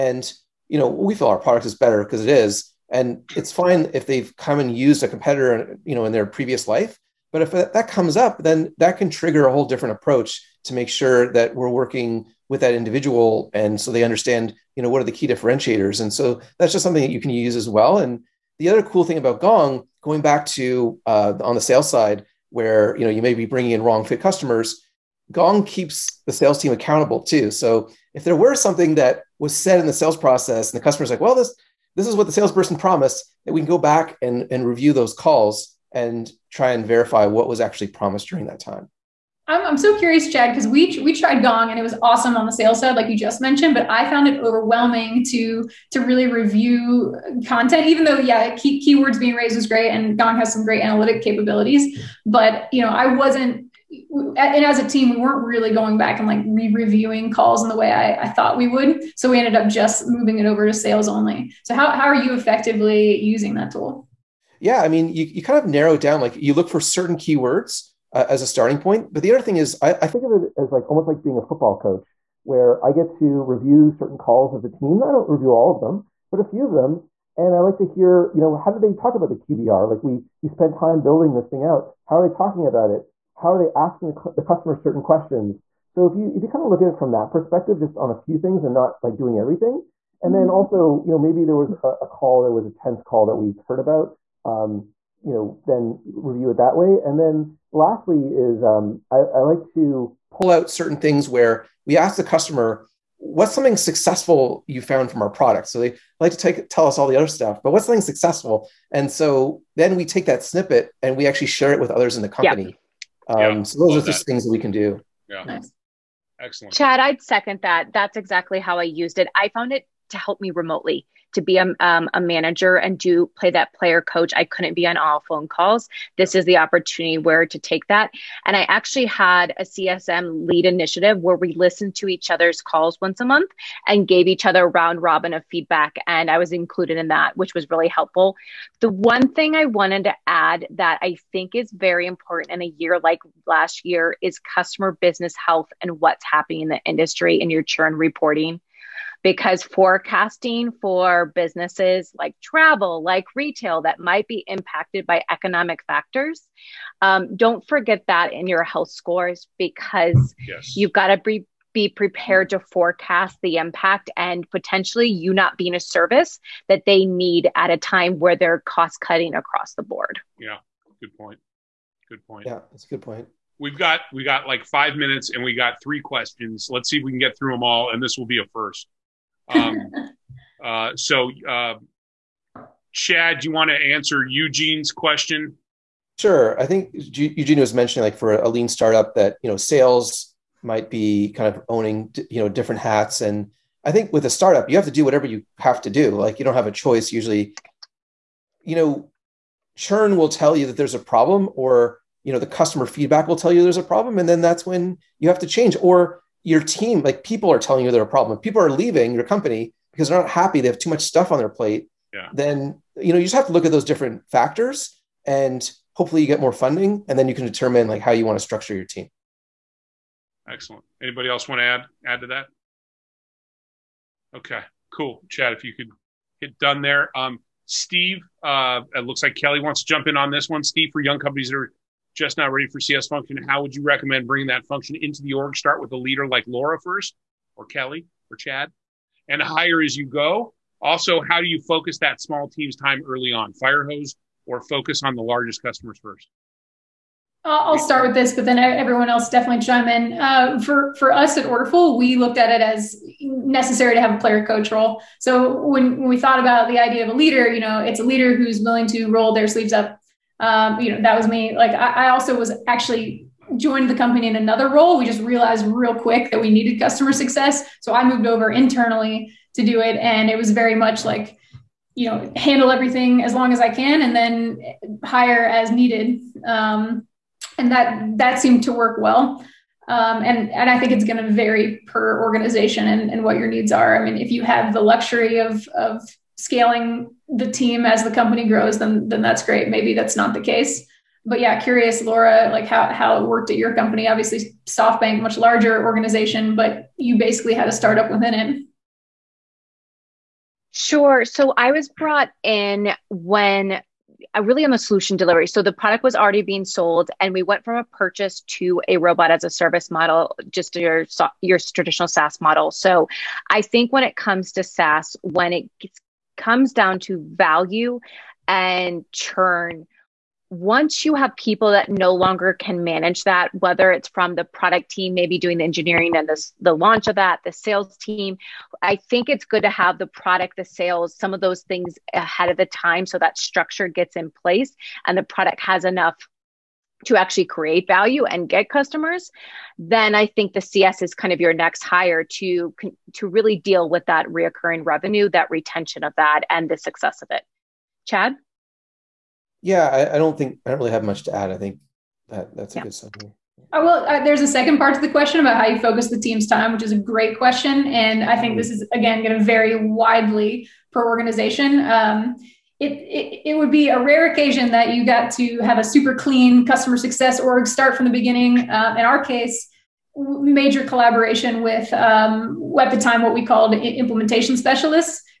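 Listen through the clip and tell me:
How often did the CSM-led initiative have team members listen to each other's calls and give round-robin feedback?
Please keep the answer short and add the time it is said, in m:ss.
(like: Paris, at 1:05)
once a month, at 2:13.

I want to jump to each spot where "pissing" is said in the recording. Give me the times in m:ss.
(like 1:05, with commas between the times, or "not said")
not said.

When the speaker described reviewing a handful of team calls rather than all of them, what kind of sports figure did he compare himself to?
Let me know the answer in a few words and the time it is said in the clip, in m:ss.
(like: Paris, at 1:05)
football coach, at 1:11.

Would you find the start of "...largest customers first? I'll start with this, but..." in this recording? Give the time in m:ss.
4:05.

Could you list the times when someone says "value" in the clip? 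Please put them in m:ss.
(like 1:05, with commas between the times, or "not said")
5:17, 5:37.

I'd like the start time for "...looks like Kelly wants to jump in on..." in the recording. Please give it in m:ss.
3:49.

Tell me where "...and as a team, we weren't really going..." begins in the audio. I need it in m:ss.
0:54.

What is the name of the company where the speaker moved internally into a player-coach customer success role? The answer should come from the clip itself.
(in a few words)
Orderful.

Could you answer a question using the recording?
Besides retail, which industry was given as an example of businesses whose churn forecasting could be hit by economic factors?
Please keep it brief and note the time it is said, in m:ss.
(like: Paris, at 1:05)
travel, at 2:32.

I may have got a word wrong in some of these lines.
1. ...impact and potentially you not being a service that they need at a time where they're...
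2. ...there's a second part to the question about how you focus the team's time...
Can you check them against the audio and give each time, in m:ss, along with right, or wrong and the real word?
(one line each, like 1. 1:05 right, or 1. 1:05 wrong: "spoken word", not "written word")
1. 2:43 right
2. 5:54 right.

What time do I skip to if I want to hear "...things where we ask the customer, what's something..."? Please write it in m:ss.
1:40.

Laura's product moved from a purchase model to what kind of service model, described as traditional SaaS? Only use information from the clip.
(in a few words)
robot as a service.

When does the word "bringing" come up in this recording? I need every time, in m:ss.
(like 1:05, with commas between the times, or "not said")
0:23, 3:54.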